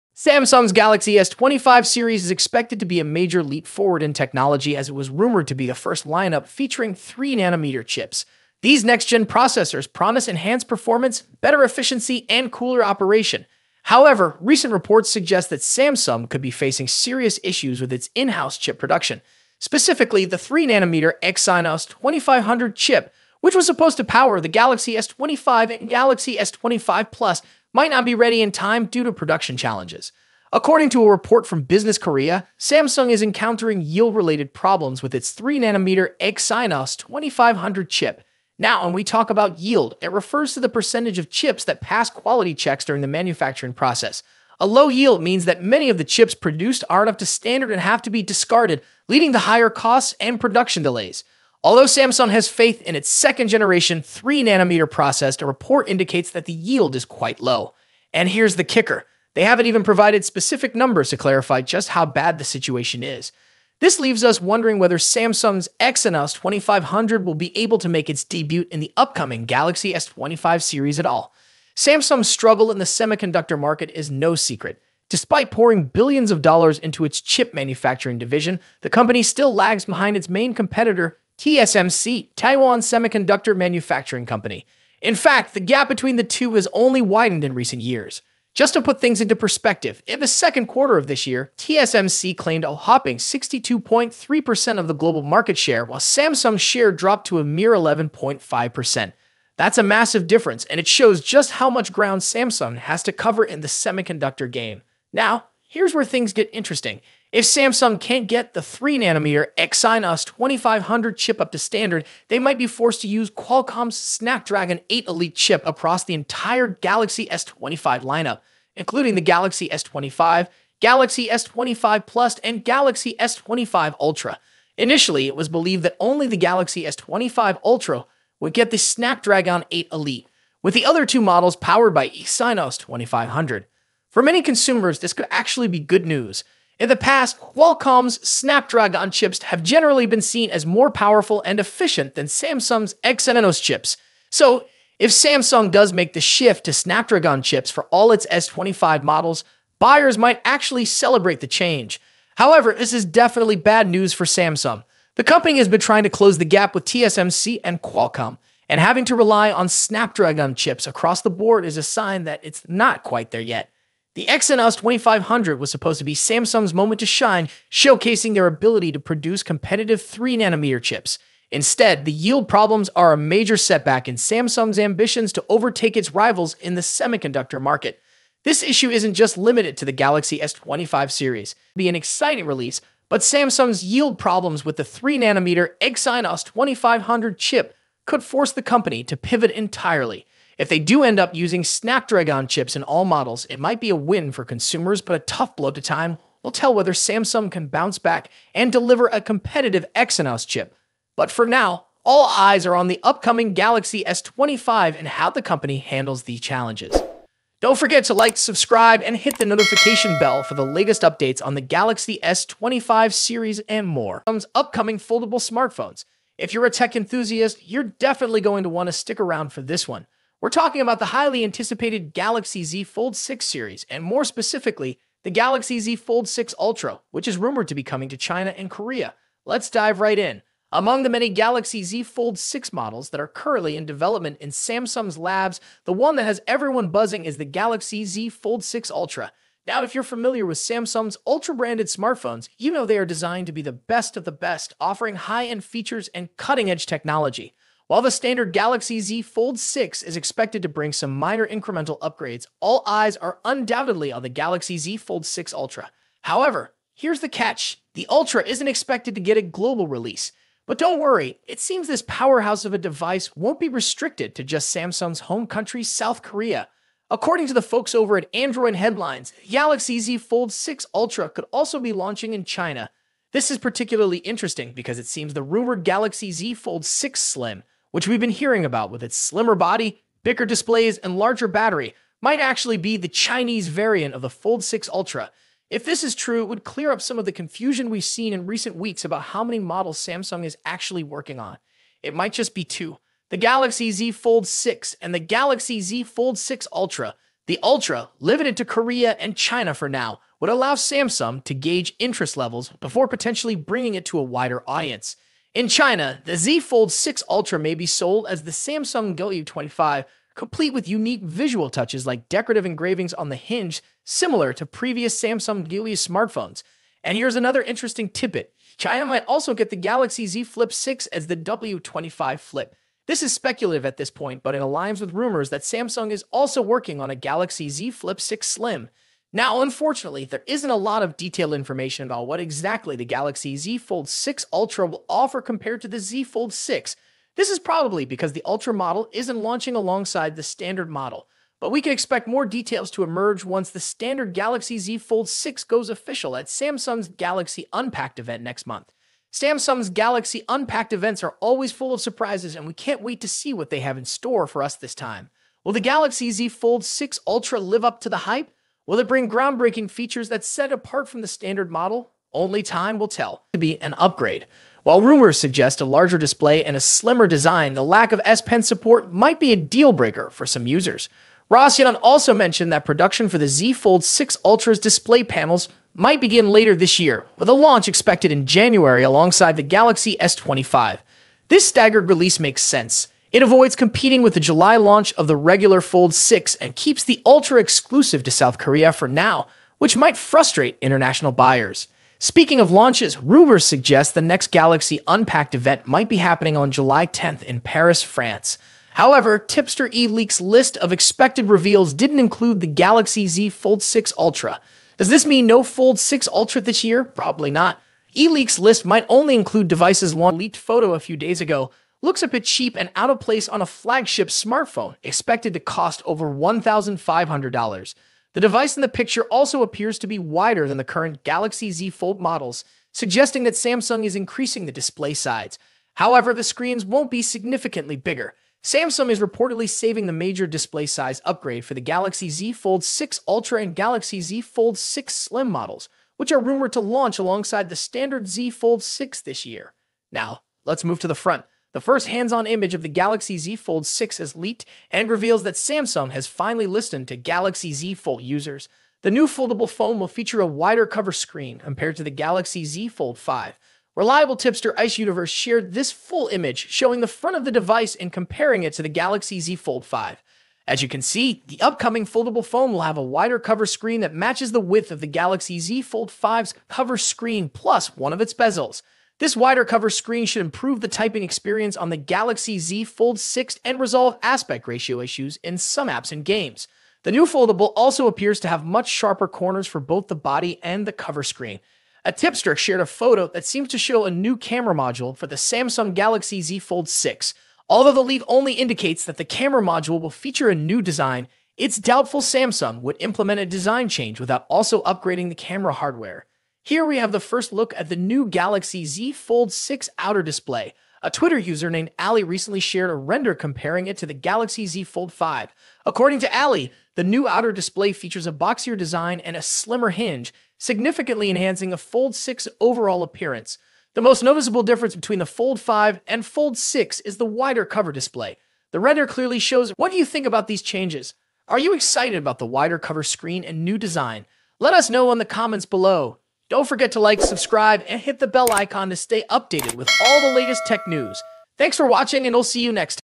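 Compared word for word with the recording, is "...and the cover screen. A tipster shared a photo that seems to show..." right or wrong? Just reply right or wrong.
right.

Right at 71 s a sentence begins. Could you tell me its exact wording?
Samsung's struggle in the semiconductor market is no secret.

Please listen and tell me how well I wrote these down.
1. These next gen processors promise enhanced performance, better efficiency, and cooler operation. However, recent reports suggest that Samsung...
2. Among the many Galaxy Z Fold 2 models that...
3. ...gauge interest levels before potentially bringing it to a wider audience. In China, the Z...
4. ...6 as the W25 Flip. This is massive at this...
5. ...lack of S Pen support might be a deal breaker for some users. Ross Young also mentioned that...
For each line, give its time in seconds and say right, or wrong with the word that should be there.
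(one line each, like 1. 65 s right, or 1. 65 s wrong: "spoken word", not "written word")
1. 8 s right
2. 230 s wrong: "6", not "2"
3. 301 s right
4. 320 s wrong: "speculative", not "massive"
5. 367 s right.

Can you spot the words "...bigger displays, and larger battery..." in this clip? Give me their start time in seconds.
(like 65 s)
280 s.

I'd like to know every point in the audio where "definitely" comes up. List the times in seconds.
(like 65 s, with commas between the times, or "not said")
153 s, 217 s.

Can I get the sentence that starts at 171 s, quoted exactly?
Instead, the yield problems are a major setback in Samsung's ambitions to overtake its rivals in the semiconductor market.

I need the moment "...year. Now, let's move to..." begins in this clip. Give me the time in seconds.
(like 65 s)
439 s.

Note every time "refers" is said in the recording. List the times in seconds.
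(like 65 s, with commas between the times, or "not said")
40 s.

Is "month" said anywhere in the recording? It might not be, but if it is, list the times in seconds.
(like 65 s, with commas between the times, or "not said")
348 s.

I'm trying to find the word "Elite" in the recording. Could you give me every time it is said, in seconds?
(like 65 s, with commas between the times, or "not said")
115 s, 129 s.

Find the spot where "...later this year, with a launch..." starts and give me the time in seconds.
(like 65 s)
376 s.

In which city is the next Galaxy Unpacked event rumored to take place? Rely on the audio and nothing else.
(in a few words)
Paris.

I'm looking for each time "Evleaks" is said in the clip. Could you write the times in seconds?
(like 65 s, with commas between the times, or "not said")
399 s, 408 s.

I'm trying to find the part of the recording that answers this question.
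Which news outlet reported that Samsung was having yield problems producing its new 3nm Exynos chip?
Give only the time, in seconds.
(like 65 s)
31 s.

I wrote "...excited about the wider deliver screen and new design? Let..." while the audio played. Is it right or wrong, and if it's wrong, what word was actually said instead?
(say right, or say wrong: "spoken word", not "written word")
wrong: "cover", not "deliver".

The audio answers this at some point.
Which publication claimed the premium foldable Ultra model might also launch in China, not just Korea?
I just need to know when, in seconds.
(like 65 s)
268 s.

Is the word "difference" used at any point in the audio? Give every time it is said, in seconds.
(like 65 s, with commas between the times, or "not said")
100 s, 514 s.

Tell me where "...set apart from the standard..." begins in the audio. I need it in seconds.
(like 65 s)
360 s.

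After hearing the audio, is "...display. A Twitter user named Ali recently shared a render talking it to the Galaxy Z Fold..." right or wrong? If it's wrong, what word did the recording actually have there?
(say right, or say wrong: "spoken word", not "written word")
wrong: "comparing", not "talking".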